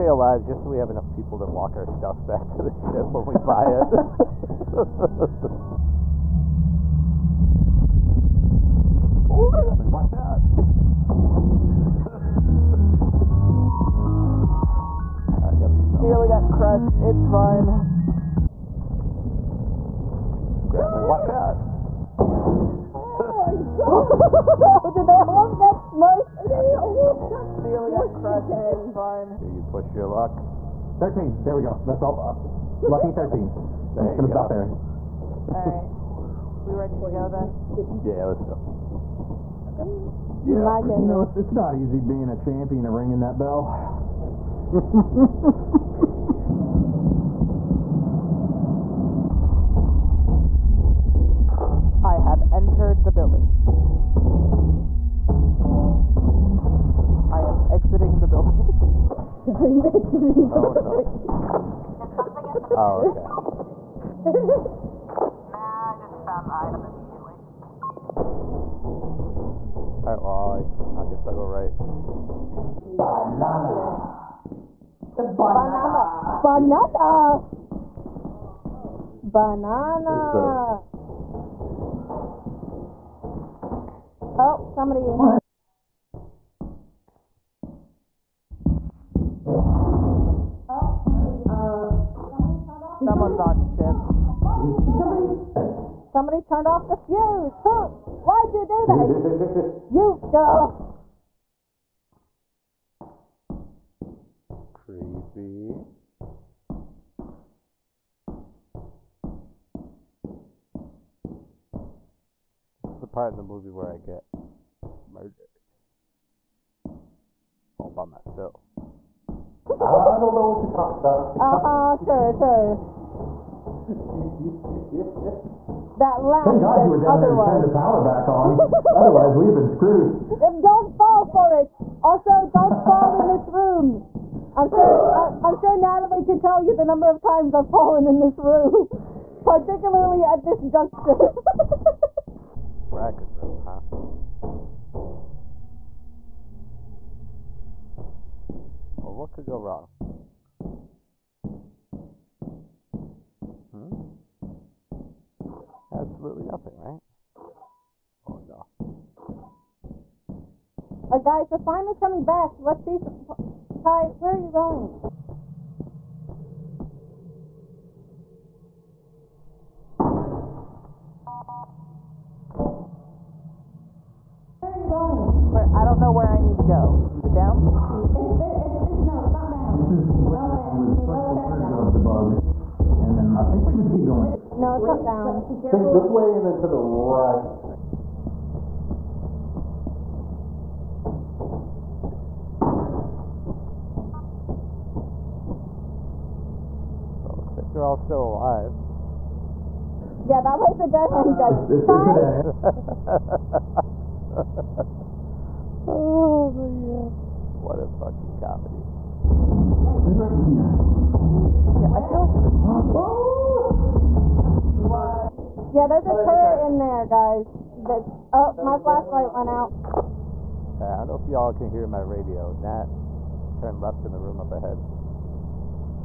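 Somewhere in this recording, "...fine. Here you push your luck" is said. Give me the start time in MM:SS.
00:28.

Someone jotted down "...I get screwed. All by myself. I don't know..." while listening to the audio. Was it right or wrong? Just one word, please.
wrong.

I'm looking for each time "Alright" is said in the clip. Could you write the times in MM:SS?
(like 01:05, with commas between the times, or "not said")
00:35, 01:10.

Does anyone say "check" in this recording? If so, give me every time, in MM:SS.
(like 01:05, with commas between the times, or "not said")
03:01.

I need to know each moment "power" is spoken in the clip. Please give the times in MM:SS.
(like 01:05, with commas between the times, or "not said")
02:07.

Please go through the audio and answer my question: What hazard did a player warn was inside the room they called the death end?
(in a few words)
A turret.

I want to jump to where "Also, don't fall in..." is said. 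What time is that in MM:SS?
02:12.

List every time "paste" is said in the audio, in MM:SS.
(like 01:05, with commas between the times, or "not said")
not said.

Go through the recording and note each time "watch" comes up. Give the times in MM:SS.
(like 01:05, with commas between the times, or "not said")
00:09, 00:21.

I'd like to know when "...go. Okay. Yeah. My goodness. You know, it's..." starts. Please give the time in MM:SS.
00:38.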